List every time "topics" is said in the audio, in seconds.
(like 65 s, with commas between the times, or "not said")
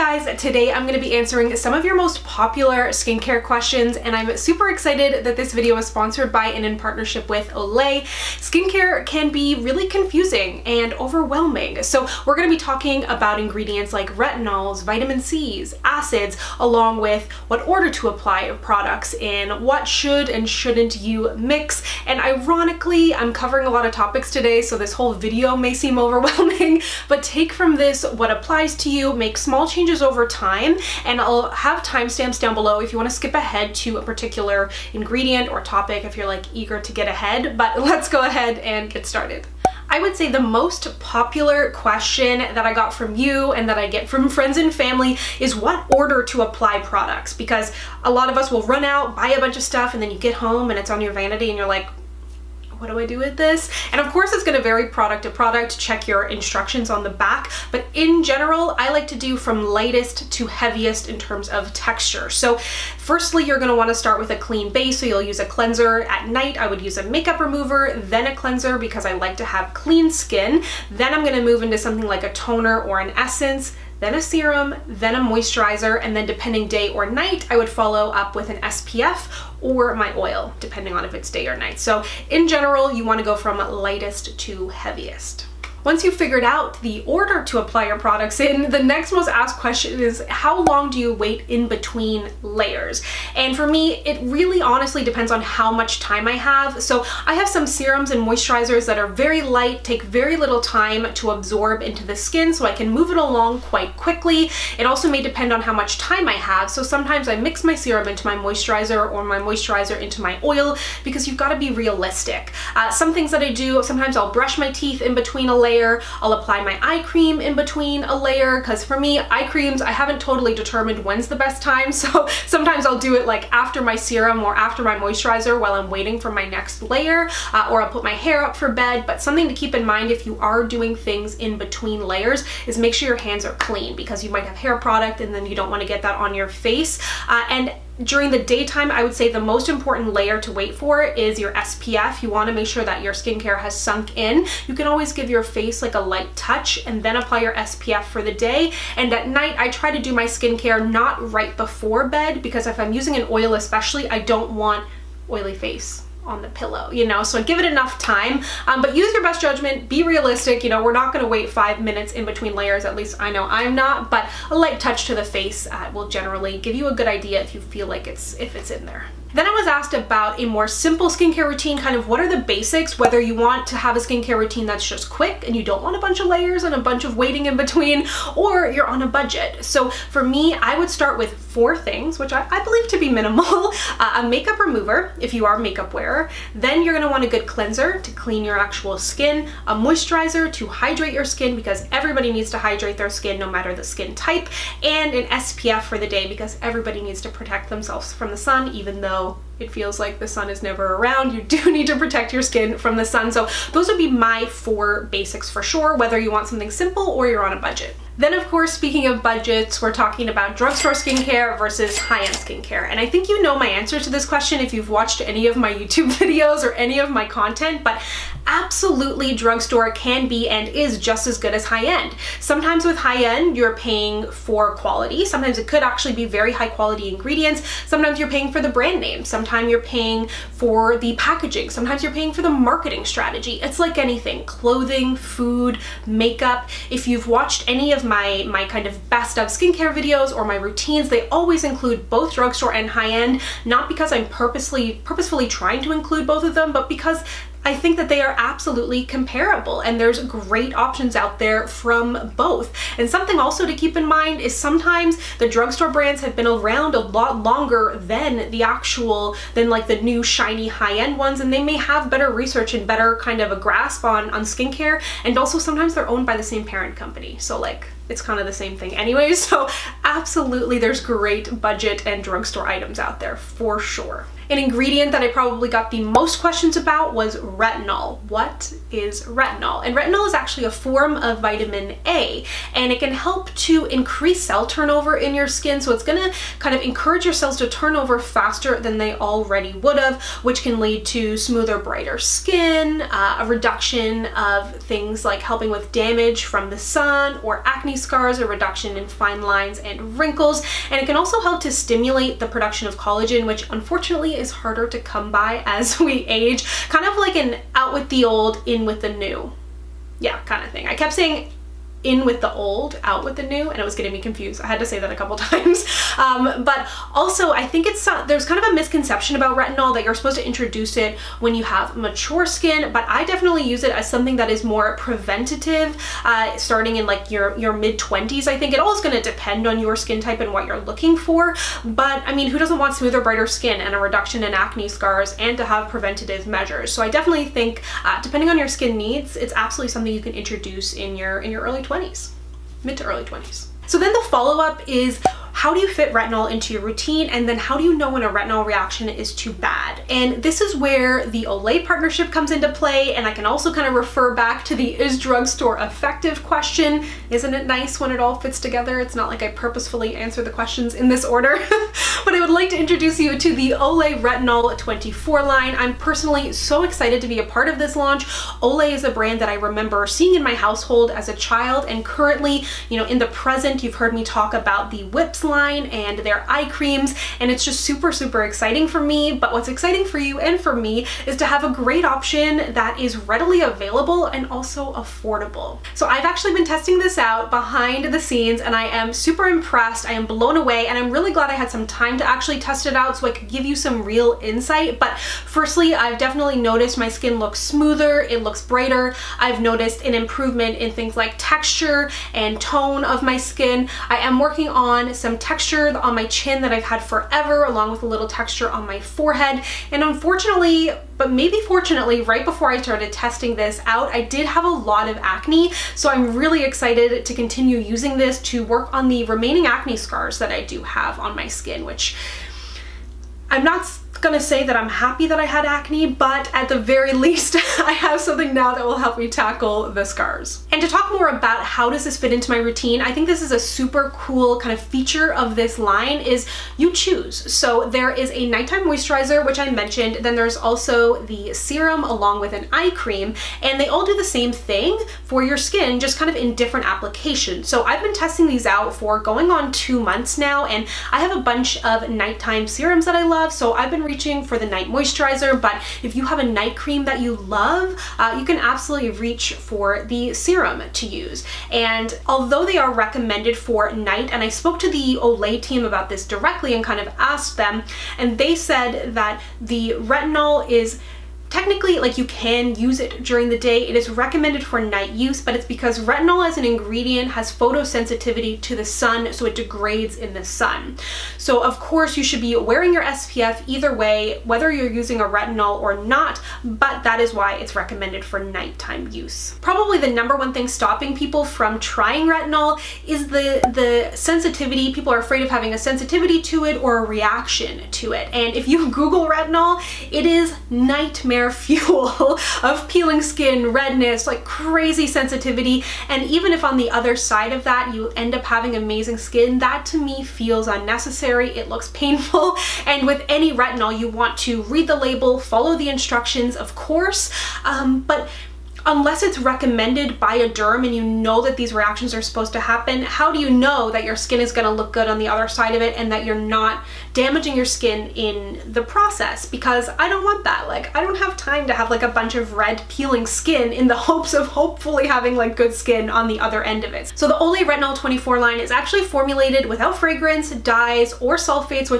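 23 s, 35 s.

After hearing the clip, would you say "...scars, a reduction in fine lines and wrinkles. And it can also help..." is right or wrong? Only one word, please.
right.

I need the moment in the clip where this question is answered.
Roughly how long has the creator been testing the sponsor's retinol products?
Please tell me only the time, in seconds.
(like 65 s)
449 s.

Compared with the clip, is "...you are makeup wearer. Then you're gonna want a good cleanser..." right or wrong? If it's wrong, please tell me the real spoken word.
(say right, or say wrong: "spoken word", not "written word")
right.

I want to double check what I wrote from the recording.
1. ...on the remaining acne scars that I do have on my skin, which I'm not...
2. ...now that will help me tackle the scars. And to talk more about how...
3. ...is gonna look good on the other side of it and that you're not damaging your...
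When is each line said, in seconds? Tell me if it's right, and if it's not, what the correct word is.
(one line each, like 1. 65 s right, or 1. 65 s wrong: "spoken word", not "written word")
1. 418 s right
2. 428 s right
3. 524 s right.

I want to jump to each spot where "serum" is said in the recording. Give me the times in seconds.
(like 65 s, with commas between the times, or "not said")
74 s, 97 s, 107 s, 123 s, 441 s, 452 s, 460 s.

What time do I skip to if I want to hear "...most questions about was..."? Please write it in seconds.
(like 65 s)
276 s.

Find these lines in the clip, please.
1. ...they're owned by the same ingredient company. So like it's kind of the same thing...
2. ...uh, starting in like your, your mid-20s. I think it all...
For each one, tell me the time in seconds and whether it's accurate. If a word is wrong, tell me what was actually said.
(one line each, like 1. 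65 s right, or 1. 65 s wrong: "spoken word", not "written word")
1. 265 s wrong: "parent", not "ingredient"
2. 326 s right.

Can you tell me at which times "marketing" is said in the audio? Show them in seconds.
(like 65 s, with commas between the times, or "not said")
232 s.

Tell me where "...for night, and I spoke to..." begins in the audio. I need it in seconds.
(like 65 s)
463 s.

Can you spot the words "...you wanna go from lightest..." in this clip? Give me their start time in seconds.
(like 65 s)
82 s.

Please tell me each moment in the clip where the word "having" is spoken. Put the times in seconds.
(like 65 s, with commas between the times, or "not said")
495 s, 508 s, 535 s.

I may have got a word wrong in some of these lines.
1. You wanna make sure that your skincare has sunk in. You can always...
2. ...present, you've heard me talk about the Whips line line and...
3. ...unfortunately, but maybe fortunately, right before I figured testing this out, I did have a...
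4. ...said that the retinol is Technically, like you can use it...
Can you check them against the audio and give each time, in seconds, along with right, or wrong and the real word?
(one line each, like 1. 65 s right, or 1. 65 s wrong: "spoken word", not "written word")
1. 142 s right
2. 373 s right
3. 410 s wrong: "started", not "figured"
4. 468 s right.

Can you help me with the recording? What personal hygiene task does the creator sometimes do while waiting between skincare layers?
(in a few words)
brush my teeth.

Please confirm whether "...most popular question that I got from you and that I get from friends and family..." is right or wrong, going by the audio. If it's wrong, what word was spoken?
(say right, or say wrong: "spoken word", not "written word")
right.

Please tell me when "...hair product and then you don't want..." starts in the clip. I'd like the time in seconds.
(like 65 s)
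134 s.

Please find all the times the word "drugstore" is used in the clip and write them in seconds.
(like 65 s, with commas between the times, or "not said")
210 s, 219 s, 242 s, 255 s, 272 s, 355 s.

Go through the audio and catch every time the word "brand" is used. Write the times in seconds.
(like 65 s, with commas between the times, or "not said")
228 s, 255 s, 369 s.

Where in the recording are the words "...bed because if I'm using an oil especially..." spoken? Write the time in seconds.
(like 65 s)
152 s.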